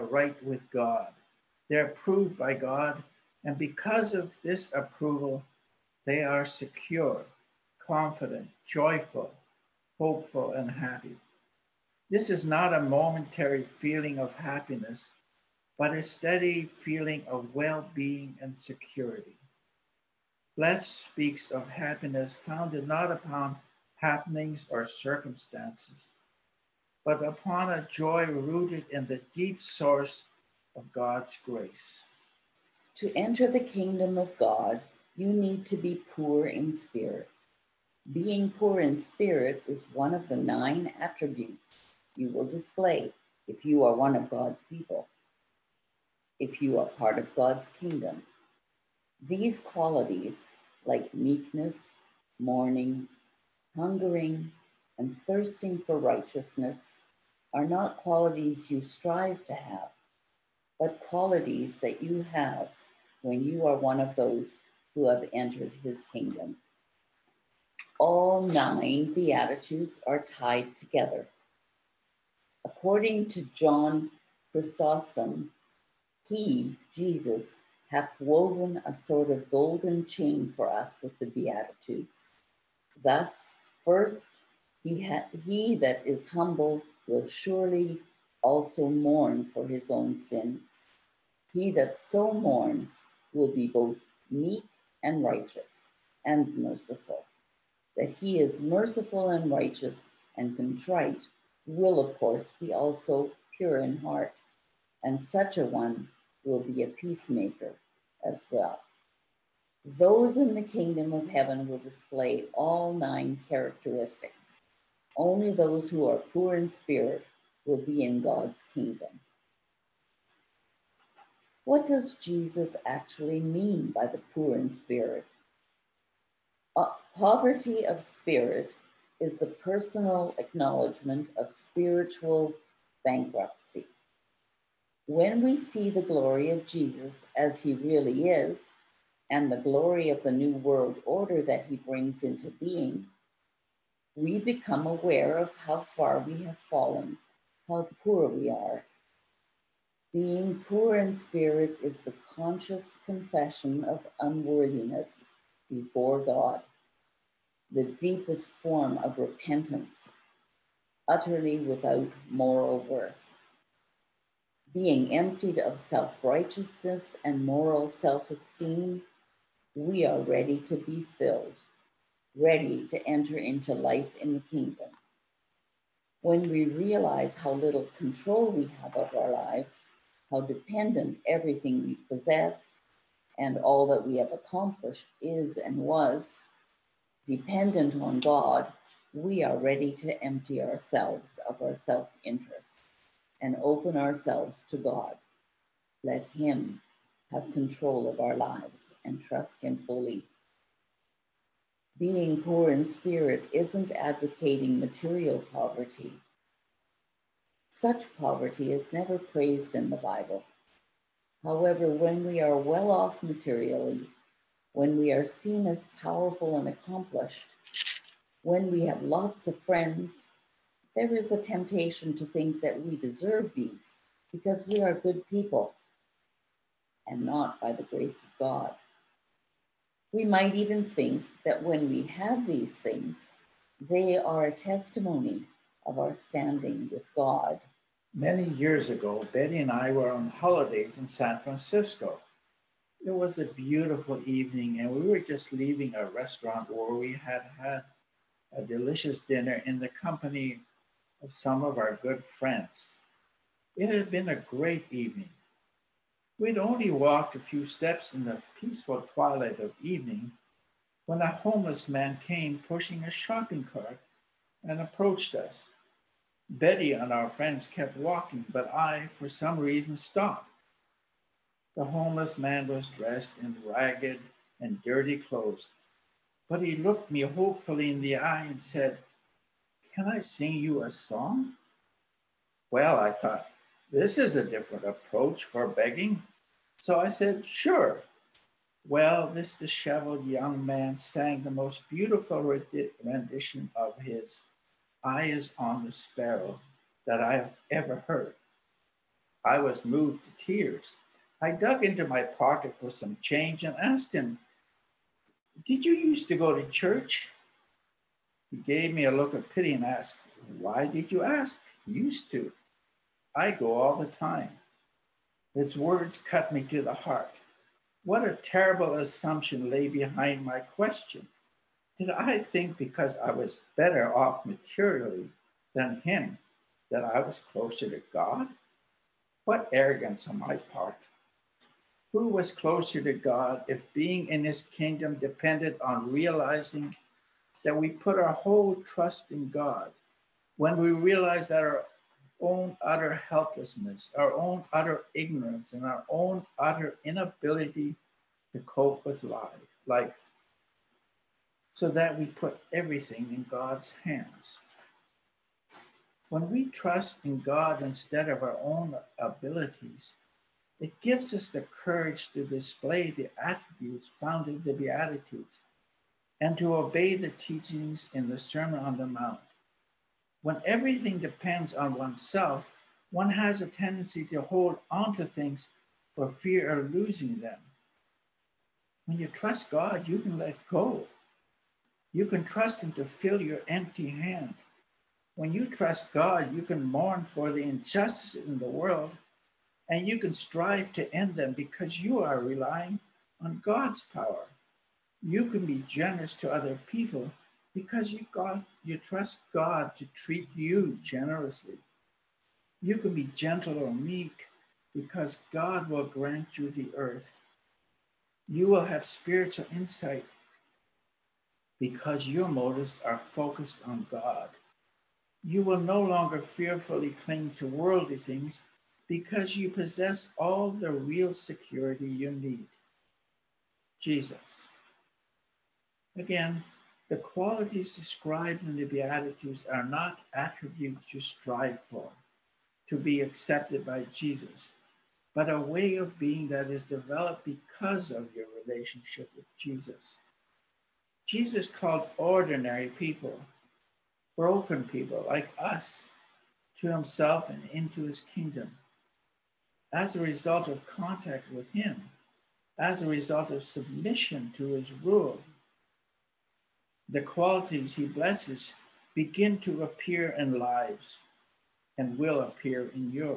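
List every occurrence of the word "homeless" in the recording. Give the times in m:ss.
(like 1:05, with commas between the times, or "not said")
4:21, 4:31.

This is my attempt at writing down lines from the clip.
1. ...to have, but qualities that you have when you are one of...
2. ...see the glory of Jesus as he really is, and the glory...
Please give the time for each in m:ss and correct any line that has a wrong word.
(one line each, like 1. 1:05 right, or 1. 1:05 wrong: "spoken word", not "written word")
1. 0:59 right
2. 2:15 right.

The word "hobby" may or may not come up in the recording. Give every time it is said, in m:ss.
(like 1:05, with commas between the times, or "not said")
not said.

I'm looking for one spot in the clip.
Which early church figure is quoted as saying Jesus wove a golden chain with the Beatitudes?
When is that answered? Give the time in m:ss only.
1:13.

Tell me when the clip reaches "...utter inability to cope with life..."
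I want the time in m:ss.
5:46.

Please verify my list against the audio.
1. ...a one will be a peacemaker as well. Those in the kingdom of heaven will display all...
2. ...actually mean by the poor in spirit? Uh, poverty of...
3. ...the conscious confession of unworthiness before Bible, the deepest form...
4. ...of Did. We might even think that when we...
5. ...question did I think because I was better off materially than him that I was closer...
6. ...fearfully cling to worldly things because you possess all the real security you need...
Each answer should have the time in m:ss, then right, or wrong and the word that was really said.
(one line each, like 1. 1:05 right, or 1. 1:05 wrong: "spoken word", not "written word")
1. 1:45 right
2. 2:02 right
3. 2:32 wrong: "God", not "Bible"
4. 3:48 wrong: "God", not "Did"
5. 5:20 right
6. 6:56 right.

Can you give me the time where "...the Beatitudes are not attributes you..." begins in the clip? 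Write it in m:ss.
7:08.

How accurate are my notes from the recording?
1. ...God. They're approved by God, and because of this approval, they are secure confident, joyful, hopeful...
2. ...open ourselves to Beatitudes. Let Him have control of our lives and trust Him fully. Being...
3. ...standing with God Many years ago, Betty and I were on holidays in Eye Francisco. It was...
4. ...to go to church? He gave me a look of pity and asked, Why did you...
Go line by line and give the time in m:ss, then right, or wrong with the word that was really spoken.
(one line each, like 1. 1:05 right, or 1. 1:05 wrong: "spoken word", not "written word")
1. 0:00 right
2. 3:13 wrong: "God", not "Beatitudes"
3. 3:56 wrong: "San", not "Eye"
4. 5:06 right.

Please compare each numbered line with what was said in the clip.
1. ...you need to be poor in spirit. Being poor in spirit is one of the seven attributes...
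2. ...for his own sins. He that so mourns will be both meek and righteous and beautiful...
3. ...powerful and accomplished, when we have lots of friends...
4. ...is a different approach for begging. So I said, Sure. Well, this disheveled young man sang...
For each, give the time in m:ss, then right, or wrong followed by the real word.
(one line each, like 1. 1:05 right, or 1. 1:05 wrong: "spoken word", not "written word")
1. 0:35 wrong: "nine", not "seven"
2. 1:29 wrong: "merciful", not "beautiful"
3. 3:36 right
4. 4:44 right.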